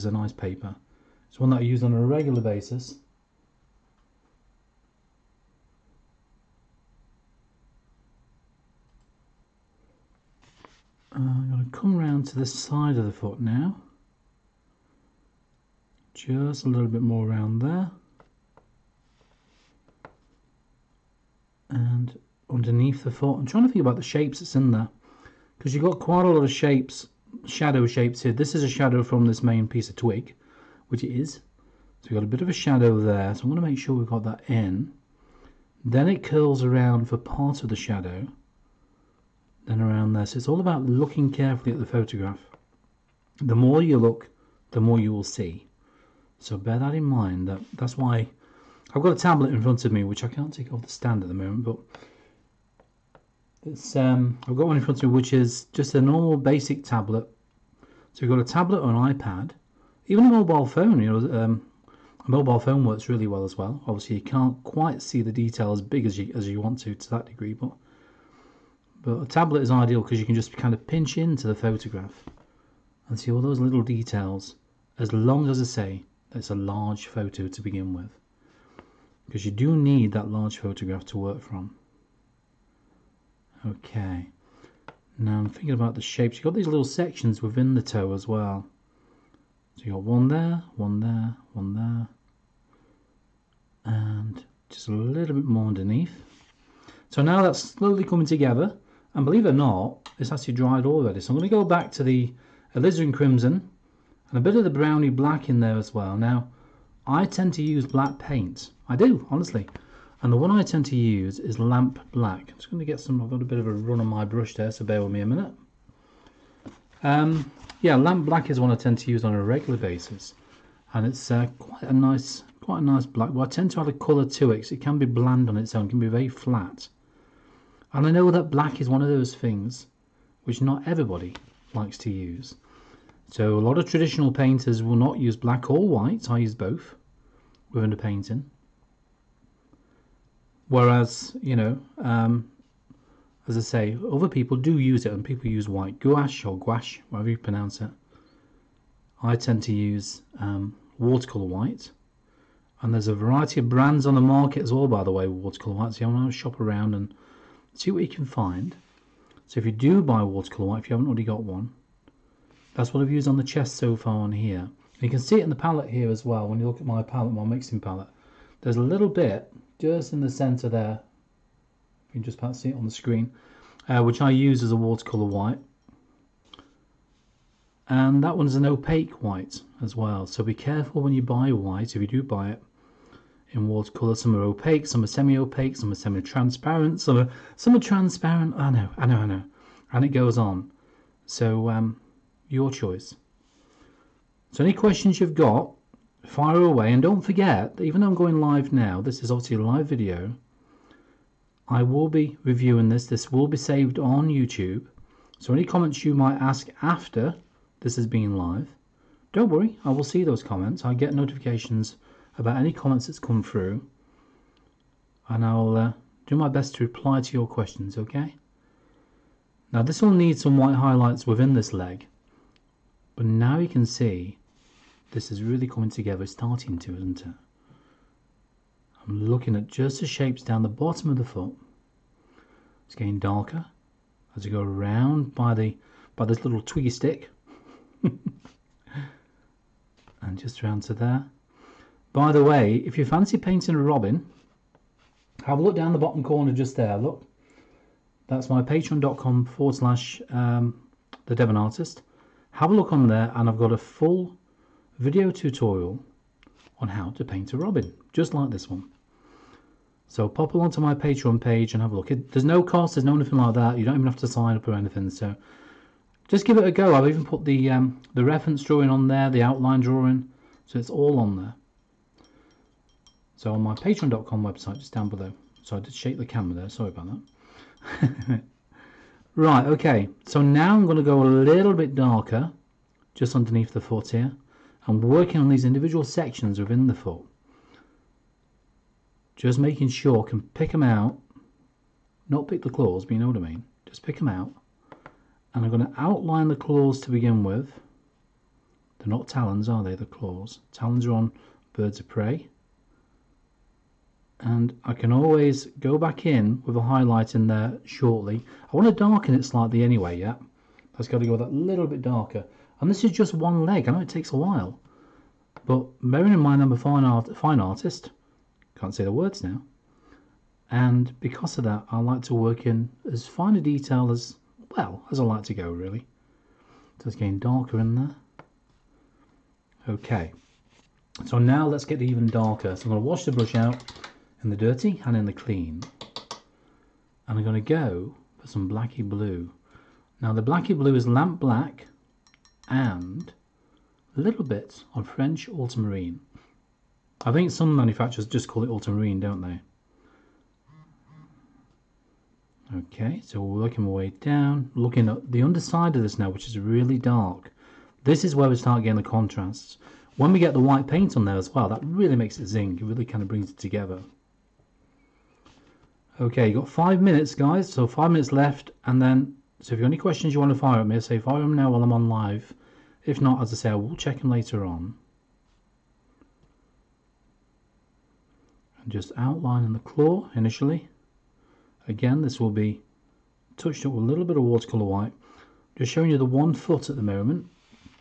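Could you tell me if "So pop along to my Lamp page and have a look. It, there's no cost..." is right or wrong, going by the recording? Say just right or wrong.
wrong.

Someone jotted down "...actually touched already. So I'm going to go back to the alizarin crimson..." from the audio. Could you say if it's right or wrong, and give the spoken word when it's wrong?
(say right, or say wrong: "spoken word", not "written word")
wrong: "dried", not "touched".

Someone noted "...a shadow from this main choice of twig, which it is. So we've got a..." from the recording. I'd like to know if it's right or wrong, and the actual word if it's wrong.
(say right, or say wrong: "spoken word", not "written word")
wrong: "piece", not "choice".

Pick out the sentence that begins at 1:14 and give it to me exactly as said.
As long as I say it's a large photo to begin with, because you do need that large photograph to work from.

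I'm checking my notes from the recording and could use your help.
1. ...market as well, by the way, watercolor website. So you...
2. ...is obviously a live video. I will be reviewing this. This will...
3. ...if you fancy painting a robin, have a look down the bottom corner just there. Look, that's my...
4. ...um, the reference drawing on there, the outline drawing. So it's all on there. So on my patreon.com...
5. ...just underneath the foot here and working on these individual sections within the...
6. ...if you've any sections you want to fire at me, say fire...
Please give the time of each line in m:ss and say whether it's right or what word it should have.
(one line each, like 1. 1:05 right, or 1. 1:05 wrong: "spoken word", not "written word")
1. 2:34 wrong: "white", not "website"
2. 3:19 right
3. 4:02 right
4. 4:27 right
5. 4:43 right
6. 6:09 wrong: "questions", not "sections".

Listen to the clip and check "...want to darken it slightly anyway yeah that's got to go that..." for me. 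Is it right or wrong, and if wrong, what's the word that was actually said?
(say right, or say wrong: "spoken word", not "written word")
right.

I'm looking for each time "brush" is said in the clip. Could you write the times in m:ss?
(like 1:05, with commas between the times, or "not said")
1:54, 5:33.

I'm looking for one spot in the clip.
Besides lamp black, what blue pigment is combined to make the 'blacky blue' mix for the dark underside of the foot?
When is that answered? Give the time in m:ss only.
5:45.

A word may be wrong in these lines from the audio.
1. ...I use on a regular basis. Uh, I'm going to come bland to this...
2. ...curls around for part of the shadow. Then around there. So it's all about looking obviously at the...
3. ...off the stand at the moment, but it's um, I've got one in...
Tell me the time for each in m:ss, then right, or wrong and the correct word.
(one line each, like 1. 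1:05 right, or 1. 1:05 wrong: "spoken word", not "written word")
1. 0:01 wrong: "round", not "bland"
2. 0:36 wrong: "carefully", not "obviously"
3. 0:50 right.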